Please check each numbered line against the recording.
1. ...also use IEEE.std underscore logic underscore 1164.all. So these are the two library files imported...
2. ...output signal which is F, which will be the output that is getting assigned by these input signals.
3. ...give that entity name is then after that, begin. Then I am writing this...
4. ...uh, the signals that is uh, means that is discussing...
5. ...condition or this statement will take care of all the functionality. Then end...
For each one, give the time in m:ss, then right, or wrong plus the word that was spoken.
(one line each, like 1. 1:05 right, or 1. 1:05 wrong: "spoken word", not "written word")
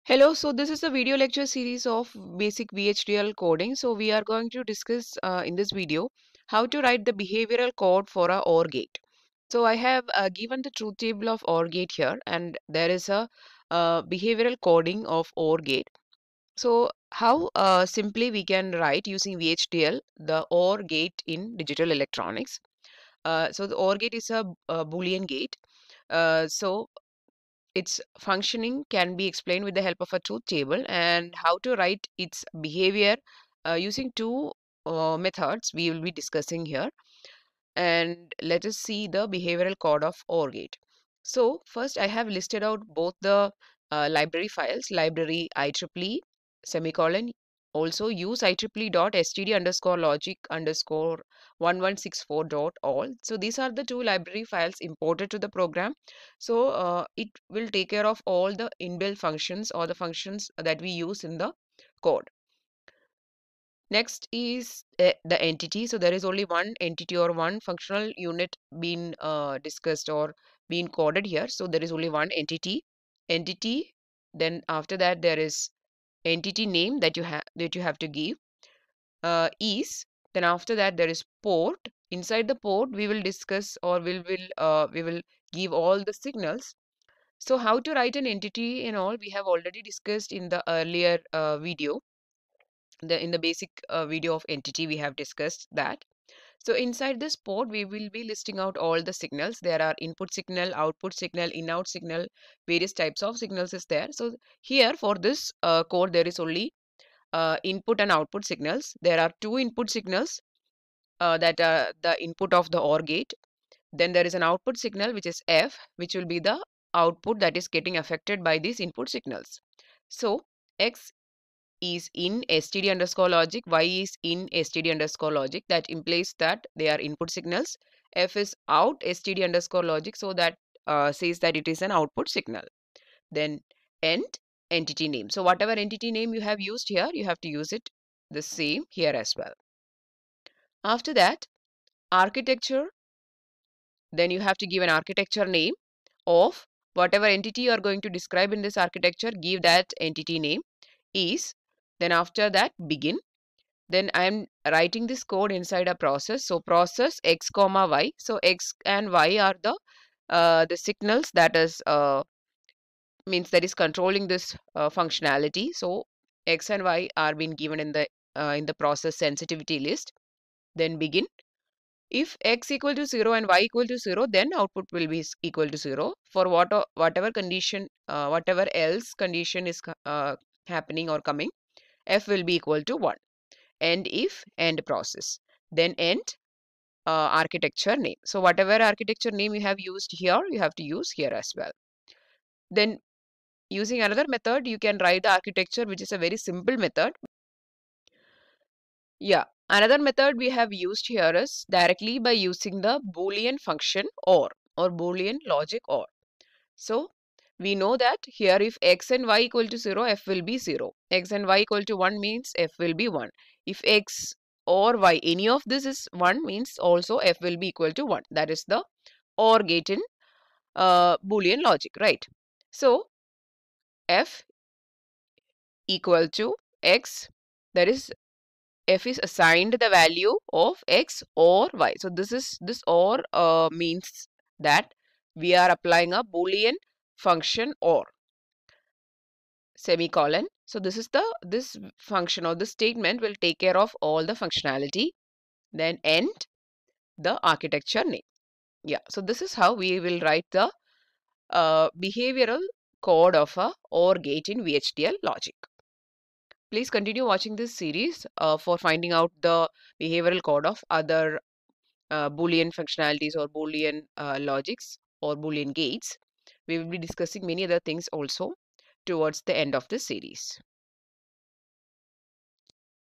1. 0:47 right
2. 1:54 wrong: "affected", not "assigned"
3. 2:29 right
4. 2:40 wrong: "controlling", not "discussing"
5. 4:01 wrong: "function", not "condition".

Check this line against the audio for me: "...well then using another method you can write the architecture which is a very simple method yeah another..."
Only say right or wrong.
right.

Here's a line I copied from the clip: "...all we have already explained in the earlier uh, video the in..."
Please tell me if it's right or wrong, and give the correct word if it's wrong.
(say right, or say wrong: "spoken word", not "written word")
wrong: "discussed", not "explained".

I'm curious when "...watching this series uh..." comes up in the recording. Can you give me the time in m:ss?
4:17.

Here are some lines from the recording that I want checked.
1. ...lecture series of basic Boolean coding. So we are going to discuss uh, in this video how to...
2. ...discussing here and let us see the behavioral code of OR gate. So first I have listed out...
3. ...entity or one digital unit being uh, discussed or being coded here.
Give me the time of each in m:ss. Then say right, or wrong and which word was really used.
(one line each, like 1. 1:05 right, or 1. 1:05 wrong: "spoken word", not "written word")
1. 0:01 wrong: "VHDL", not "Boolean"
2. 0:36 right
3. 1:06 wrong: "functional", not "digital".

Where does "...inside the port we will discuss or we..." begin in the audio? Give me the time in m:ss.
1:22.